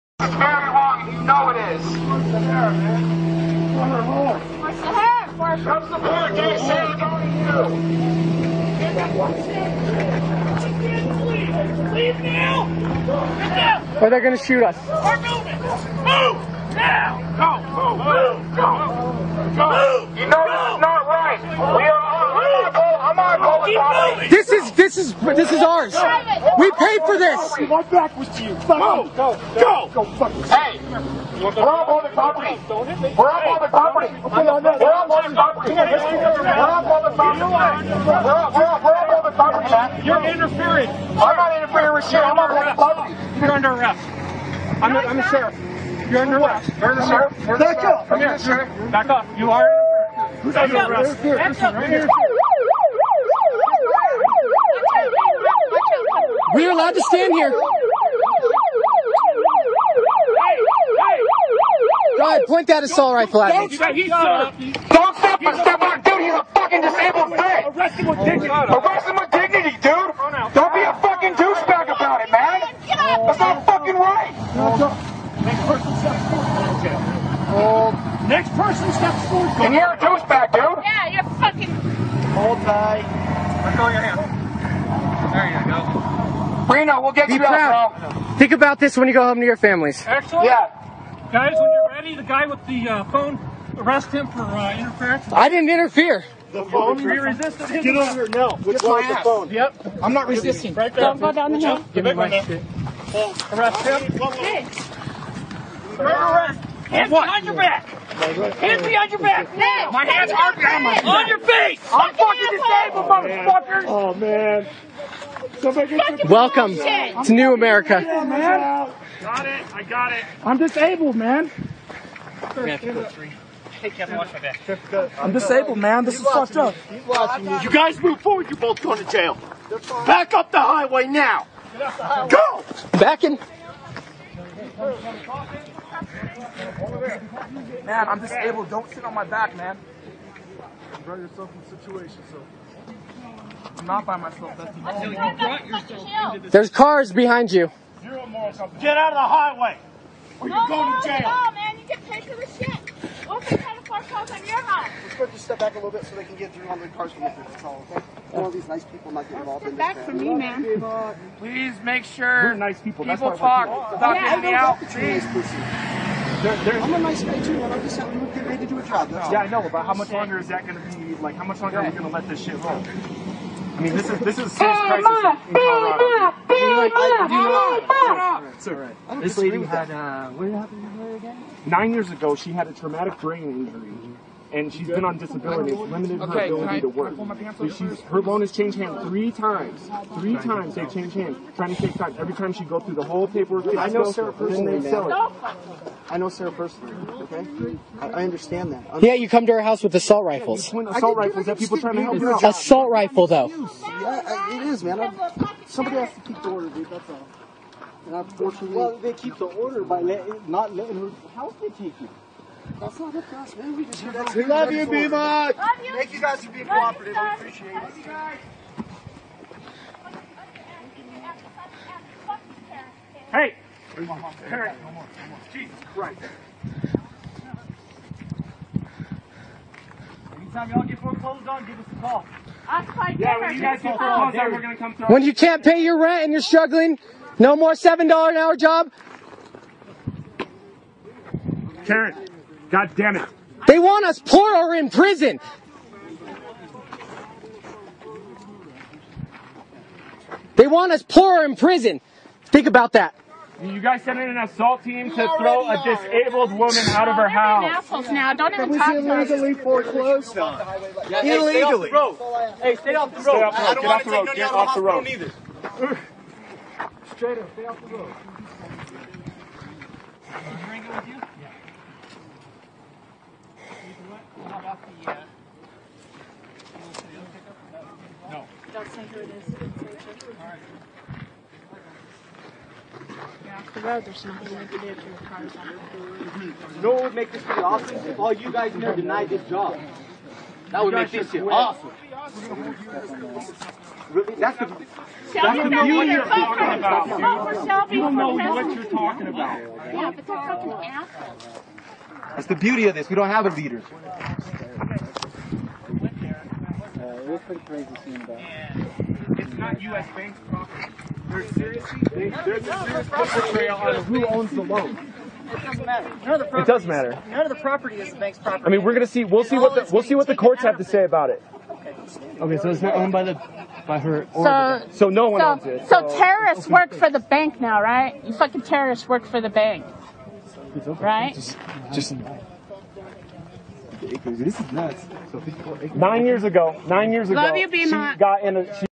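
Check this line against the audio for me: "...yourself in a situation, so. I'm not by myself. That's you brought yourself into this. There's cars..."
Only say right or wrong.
right.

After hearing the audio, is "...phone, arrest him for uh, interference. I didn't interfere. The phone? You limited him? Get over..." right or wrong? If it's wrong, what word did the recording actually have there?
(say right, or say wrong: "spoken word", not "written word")
wrong: "resisted", not "limited".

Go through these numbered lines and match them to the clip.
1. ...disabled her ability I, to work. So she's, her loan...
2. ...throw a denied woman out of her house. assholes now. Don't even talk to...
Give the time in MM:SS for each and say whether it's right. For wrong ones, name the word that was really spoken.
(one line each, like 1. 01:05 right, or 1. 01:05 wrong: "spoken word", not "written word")
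1. 03:05 wrong: "limited", not "disabled"
2. 04:15 wrong: "disabled", not "denied".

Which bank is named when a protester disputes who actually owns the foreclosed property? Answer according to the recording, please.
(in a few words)
U.S. Bank.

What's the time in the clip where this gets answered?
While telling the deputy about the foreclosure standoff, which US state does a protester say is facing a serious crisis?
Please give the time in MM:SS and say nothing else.
02:55.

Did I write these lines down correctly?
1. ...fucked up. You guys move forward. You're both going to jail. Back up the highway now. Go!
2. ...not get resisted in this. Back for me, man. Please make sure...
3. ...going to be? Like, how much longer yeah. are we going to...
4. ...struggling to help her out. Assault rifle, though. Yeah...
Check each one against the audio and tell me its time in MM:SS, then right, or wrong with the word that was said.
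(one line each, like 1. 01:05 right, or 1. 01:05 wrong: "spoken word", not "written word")
1. 02:06 right
2. 02:39 wrong: "involved", not "resisted"
3. 02:50 right
4. 03:21 wrong: "trying", not "struggling".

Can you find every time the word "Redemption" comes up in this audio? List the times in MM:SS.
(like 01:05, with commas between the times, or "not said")
not said.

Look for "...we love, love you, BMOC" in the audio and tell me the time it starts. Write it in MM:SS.
03:34.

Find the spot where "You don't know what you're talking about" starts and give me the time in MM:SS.
04:57.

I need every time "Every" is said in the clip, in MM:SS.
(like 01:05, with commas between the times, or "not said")
03:12.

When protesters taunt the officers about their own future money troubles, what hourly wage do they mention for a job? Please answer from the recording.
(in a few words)
$7.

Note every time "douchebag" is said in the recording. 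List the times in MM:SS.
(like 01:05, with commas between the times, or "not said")
01:11, 01:19.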